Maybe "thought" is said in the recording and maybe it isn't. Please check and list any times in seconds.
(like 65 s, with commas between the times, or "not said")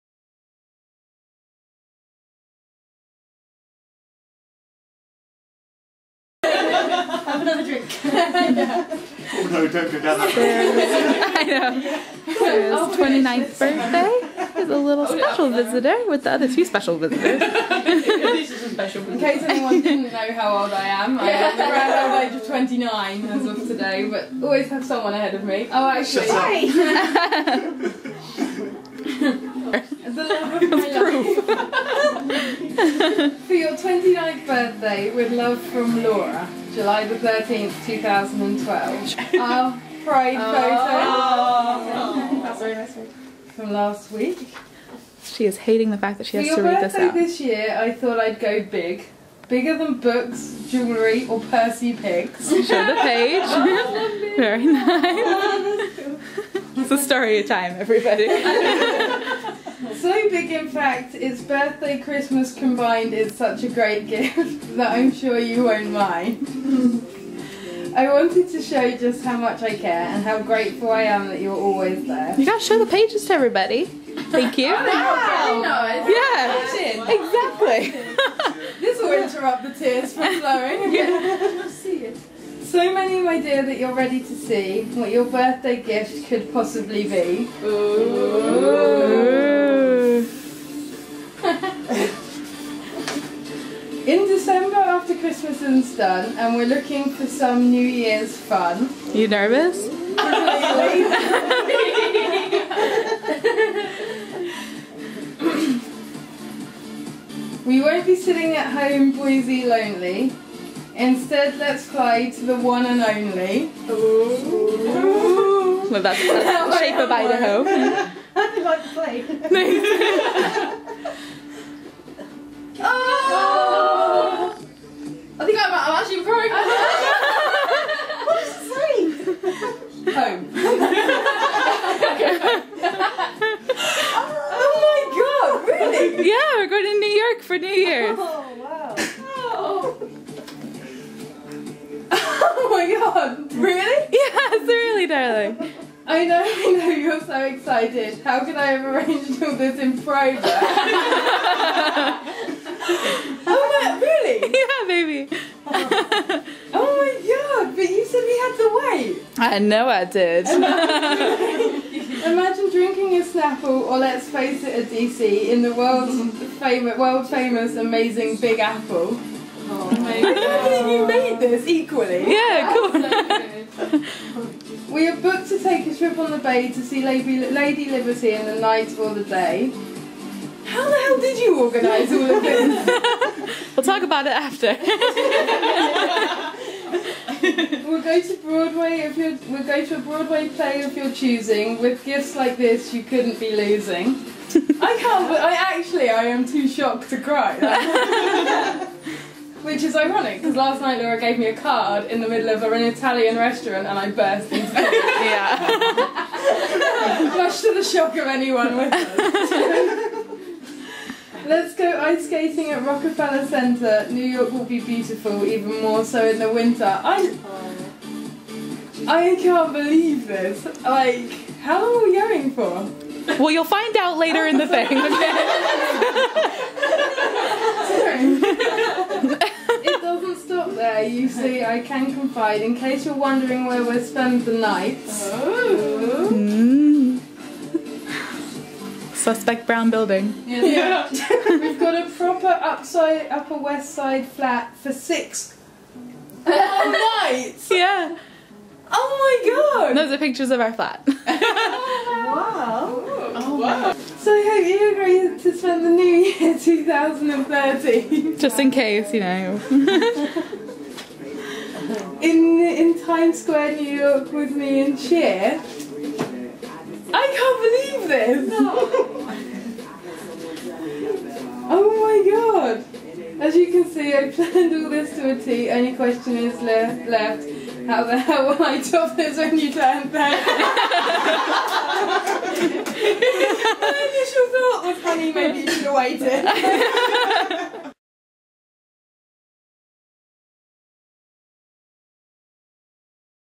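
47 s, 284 s.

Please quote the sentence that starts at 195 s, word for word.
But I actually I am too shocked to cry.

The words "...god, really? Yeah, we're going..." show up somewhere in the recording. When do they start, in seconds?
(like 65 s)
135 s.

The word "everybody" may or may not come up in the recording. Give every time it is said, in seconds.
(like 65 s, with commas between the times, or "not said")
57 s, 73 s.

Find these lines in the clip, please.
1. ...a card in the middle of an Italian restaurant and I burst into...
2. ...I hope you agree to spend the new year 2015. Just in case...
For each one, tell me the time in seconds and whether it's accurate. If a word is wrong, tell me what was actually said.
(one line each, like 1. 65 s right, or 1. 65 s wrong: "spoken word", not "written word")
1. 201 s right
2. 254 s wrong: "2013", not "2015".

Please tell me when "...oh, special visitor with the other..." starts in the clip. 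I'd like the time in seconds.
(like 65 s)
15 s.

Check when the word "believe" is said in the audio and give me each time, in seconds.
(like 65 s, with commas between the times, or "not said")
219 s, 268 s.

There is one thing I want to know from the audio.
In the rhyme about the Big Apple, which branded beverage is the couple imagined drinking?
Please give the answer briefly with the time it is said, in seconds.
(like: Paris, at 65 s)
Snapple, at 163 s.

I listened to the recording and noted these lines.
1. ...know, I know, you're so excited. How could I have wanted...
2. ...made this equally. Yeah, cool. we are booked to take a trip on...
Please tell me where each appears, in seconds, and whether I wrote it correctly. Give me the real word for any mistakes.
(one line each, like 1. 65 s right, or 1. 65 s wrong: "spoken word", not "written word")
1. 146 s wrong: "arranged", not "wanted"
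2. 171 s right.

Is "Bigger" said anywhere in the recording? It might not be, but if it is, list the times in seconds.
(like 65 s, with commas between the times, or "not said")
49 s.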